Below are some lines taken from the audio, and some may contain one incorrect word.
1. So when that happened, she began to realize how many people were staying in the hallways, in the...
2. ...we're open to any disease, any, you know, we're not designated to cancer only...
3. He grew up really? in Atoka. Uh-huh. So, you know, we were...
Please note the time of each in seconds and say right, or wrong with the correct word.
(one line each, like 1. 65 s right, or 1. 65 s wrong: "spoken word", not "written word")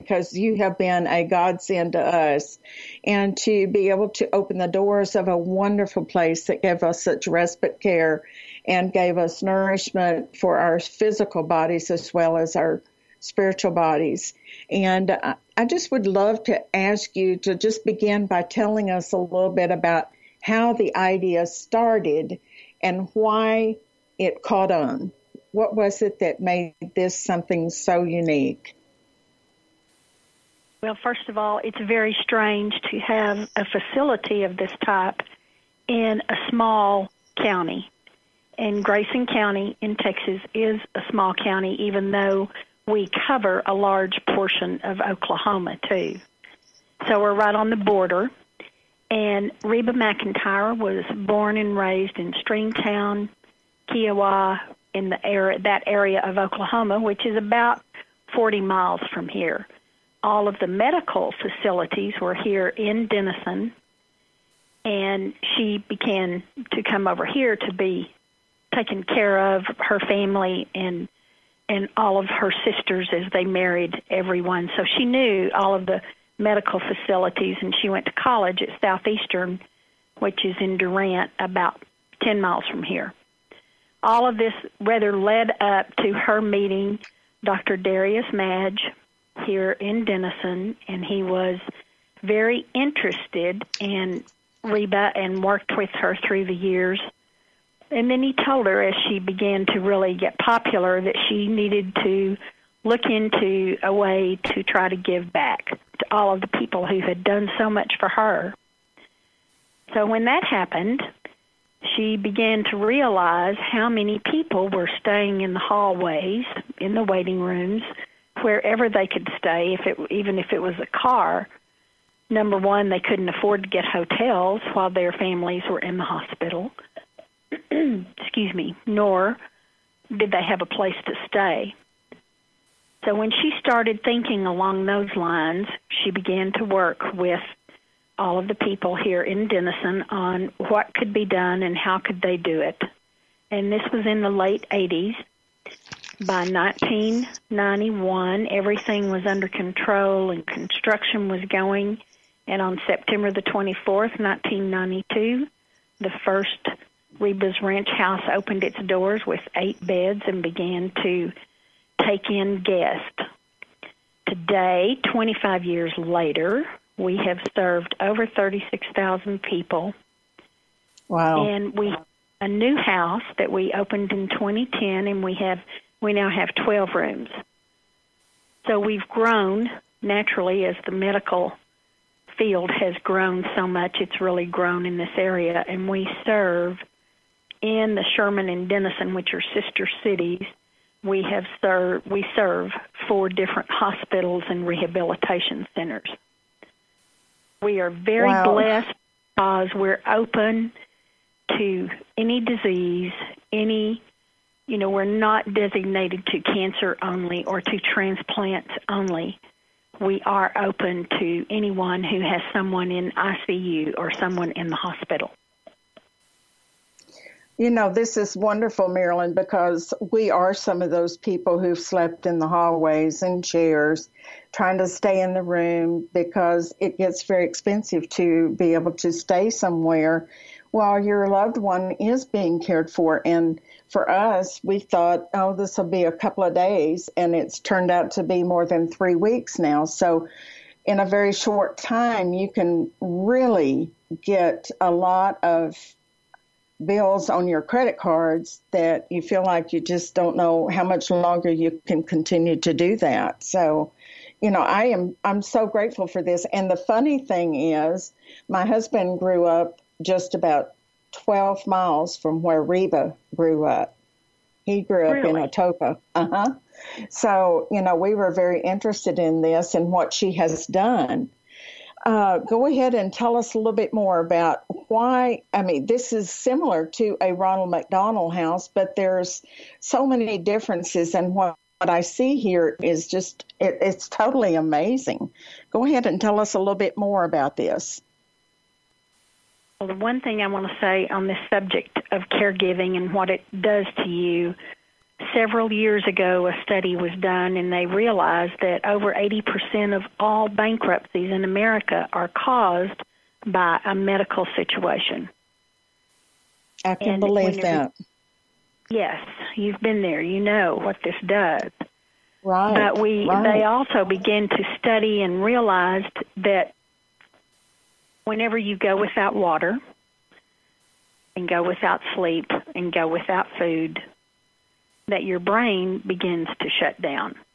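1. 109 s right
2. 199 s right
3. 264 s right.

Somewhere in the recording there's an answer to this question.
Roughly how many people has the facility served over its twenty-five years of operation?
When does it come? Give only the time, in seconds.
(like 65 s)
168 s.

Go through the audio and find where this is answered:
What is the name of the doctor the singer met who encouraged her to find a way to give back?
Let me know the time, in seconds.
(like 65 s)
87 s.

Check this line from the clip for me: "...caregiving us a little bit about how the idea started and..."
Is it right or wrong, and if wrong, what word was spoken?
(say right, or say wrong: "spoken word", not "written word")
wrong: "telling", not "caregiving".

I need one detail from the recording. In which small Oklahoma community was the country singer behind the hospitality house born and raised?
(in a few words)
Stringtown.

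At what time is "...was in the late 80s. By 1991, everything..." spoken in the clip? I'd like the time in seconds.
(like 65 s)
143 s.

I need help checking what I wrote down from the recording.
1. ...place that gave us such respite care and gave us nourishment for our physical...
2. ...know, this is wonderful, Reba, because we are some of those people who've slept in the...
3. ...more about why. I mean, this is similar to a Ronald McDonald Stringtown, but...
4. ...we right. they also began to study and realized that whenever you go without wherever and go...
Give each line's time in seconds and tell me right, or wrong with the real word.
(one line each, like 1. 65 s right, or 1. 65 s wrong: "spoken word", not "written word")
1. 6 s right
2. 217 s wrong: "Marilyn", not "Reba"
3. 273 s wrong: "House", not "Stringtown"
4. 313 s wrong: "water", not "wherever".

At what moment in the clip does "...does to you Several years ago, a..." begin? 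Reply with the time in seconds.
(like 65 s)
293 s.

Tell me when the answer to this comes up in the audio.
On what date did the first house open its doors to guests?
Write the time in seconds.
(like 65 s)
152 s.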